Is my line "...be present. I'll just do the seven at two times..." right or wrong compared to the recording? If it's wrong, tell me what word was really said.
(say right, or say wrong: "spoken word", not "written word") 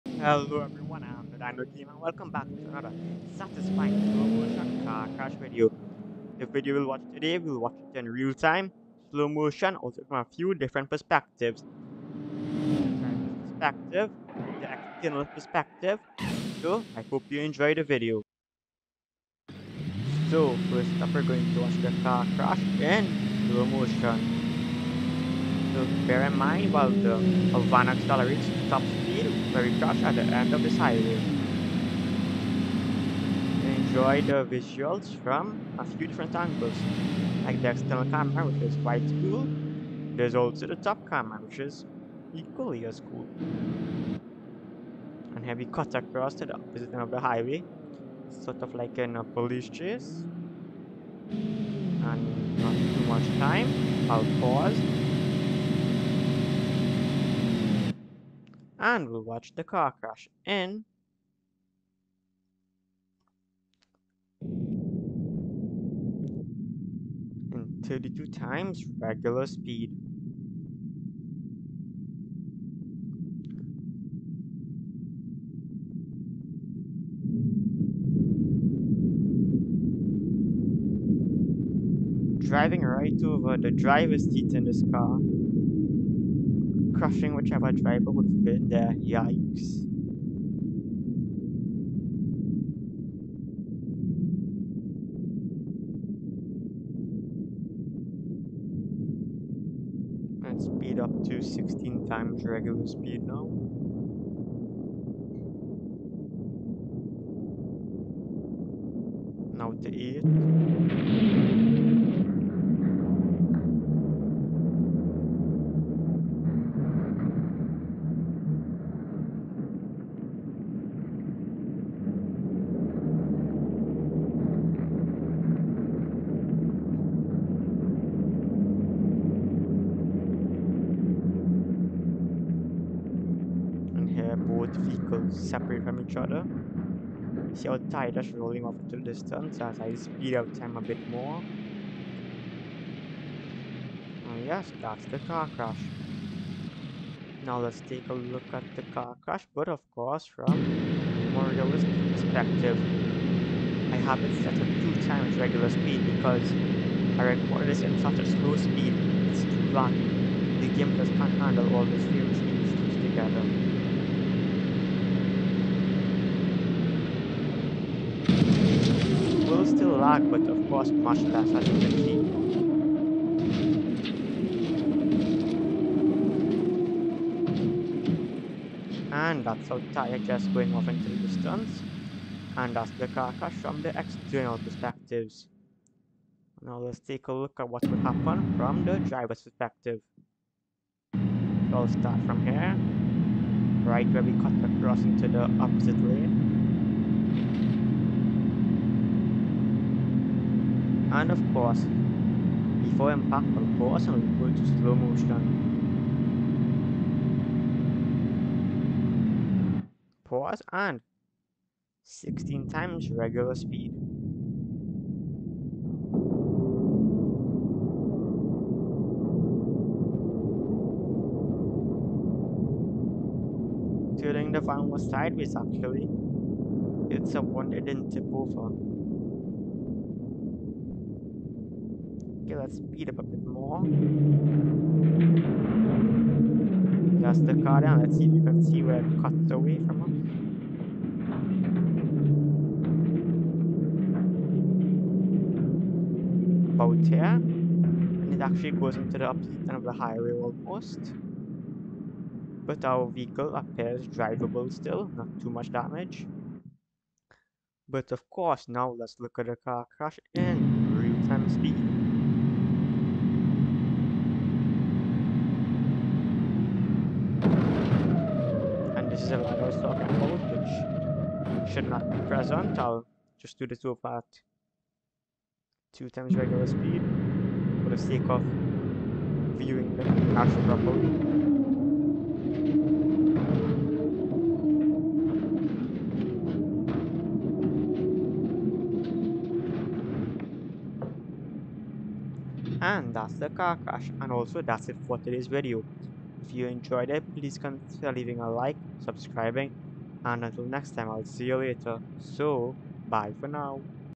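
wrong: "two", not "seven".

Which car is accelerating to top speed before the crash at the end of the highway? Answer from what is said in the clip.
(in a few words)
Havana.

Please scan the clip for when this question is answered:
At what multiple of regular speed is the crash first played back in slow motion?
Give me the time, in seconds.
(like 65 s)
67 s.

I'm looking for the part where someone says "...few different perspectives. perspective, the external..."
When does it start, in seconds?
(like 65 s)
10 s.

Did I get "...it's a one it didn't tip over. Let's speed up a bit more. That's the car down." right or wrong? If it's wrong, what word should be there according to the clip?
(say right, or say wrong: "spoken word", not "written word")
right.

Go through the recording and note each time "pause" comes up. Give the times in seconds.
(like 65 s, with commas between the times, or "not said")
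54 s, 210 s.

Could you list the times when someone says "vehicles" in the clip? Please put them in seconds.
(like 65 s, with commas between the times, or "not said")
134 s, 253 s.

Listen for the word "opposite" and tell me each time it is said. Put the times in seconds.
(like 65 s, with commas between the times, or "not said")
46 s, 195 s, 249 s.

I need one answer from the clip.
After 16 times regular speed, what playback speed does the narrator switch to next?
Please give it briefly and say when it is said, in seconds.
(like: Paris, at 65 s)
8, at 111 s.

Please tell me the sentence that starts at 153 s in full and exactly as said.
I have it set at two times regular speed because I recorded this in such a slow speed, it's too long.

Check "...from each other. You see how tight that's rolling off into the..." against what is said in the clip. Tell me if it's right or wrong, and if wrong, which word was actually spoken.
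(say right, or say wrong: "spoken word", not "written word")
right.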